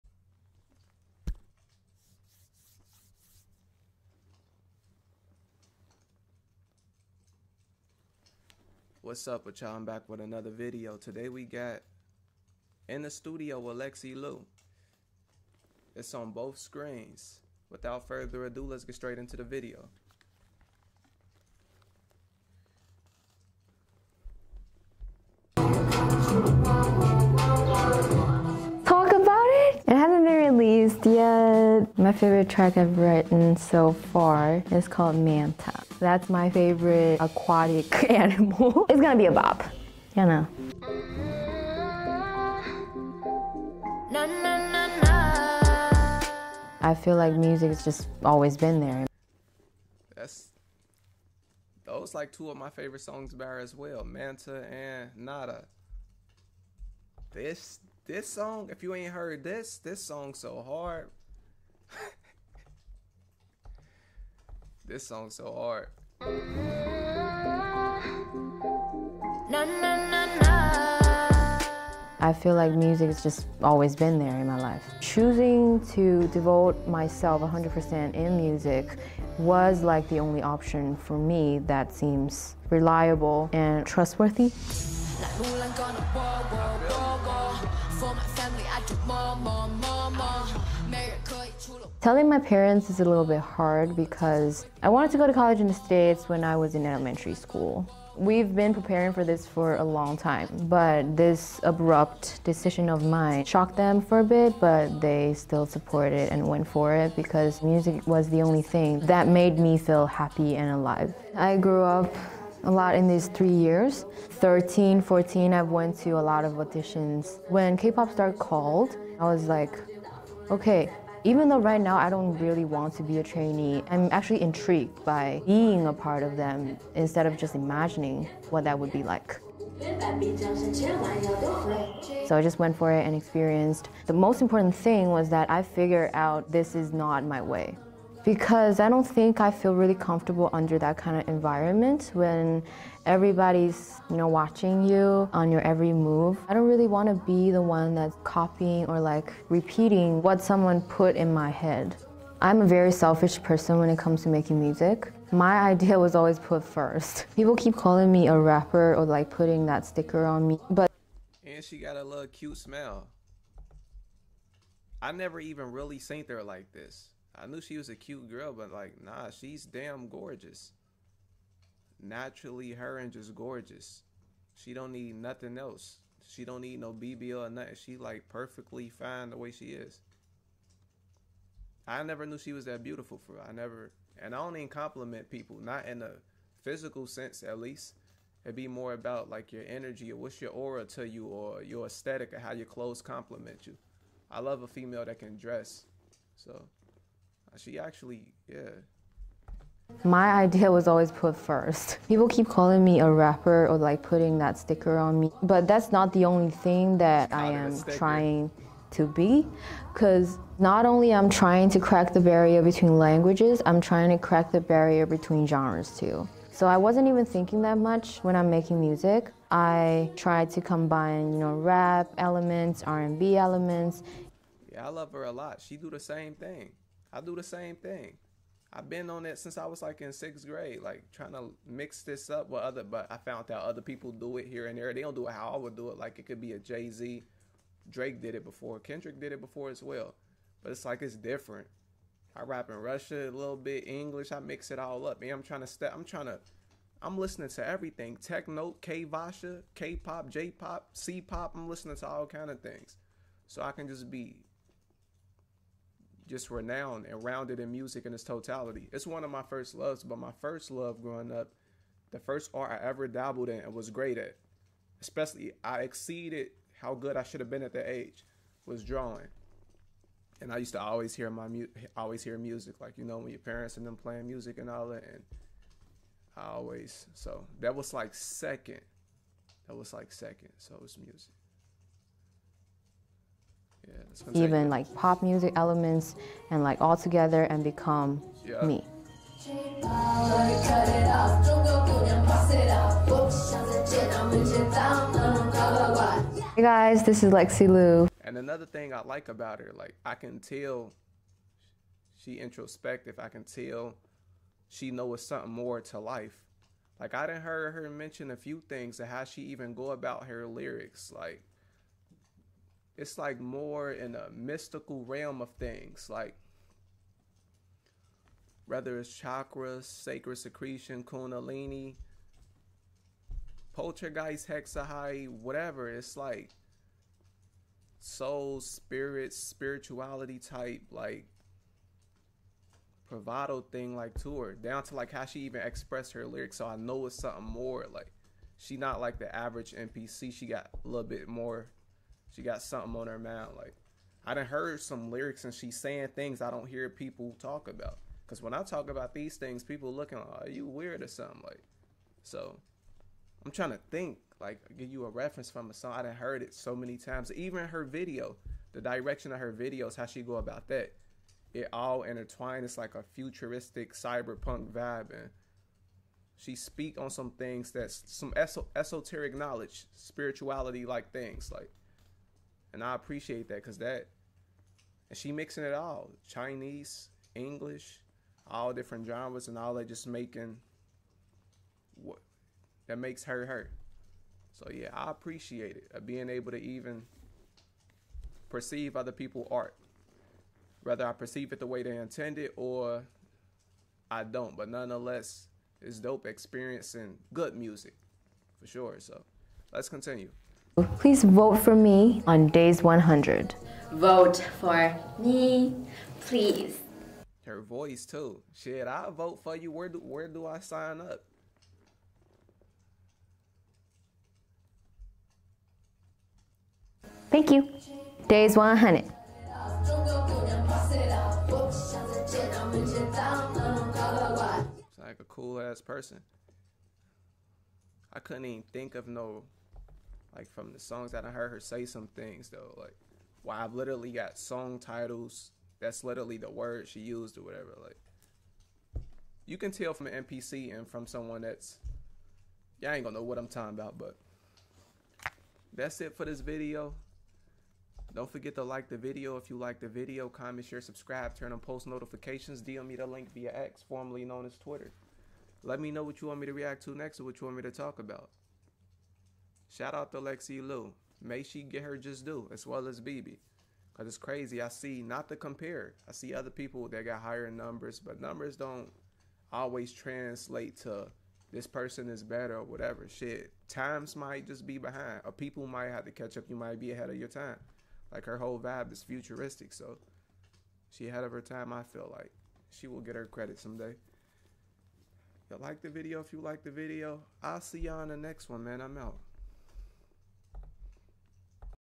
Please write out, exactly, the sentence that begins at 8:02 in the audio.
She will get her credit someday.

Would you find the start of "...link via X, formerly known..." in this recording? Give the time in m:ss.
7:33.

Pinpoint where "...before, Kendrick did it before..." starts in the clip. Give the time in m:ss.
3:58.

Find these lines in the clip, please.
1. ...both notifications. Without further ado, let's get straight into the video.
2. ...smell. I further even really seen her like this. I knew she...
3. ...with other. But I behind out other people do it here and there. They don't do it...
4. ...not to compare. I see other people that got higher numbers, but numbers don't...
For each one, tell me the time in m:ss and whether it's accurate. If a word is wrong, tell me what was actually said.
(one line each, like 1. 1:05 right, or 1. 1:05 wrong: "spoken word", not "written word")
1. 0:16 wrong: "screens", not "notifications"
2. 2:42 wrong: "never", not "further"
3. 3:52 wrong: "found", not "behind"
4. 7:45 right.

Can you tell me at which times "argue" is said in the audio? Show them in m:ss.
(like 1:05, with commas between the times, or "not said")
not said.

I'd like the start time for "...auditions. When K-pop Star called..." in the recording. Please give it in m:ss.
1:56.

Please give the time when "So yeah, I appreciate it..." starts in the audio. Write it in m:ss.
6:24.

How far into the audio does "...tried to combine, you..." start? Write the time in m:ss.
3:40.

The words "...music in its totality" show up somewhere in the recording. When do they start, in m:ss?
4:17.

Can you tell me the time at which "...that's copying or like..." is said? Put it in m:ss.
2:27.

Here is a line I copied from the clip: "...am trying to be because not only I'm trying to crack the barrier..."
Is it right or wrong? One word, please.
right.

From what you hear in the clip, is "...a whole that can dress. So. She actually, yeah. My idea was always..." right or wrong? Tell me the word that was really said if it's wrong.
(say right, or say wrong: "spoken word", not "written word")
wrong: "female", not "whole".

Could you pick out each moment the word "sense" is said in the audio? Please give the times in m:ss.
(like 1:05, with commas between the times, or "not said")
3:07.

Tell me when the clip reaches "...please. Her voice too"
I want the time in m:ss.
6:46.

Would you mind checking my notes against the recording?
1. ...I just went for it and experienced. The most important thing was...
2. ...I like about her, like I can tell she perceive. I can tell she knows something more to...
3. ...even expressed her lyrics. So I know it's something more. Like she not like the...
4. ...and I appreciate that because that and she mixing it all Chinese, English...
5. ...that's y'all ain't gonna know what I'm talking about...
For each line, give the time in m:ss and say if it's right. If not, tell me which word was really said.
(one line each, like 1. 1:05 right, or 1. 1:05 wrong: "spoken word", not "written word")
1. 2:12 right
2. 4:58 wrong: "introspective", not "perceive"
3. 5:35 right
4. 6:12 right
5. 7:21 right.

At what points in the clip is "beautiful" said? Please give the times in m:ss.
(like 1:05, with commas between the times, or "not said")
3:02.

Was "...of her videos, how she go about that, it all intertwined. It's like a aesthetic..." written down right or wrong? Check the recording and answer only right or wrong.
wrong.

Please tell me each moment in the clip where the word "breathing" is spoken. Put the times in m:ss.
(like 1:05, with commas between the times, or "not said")
not said.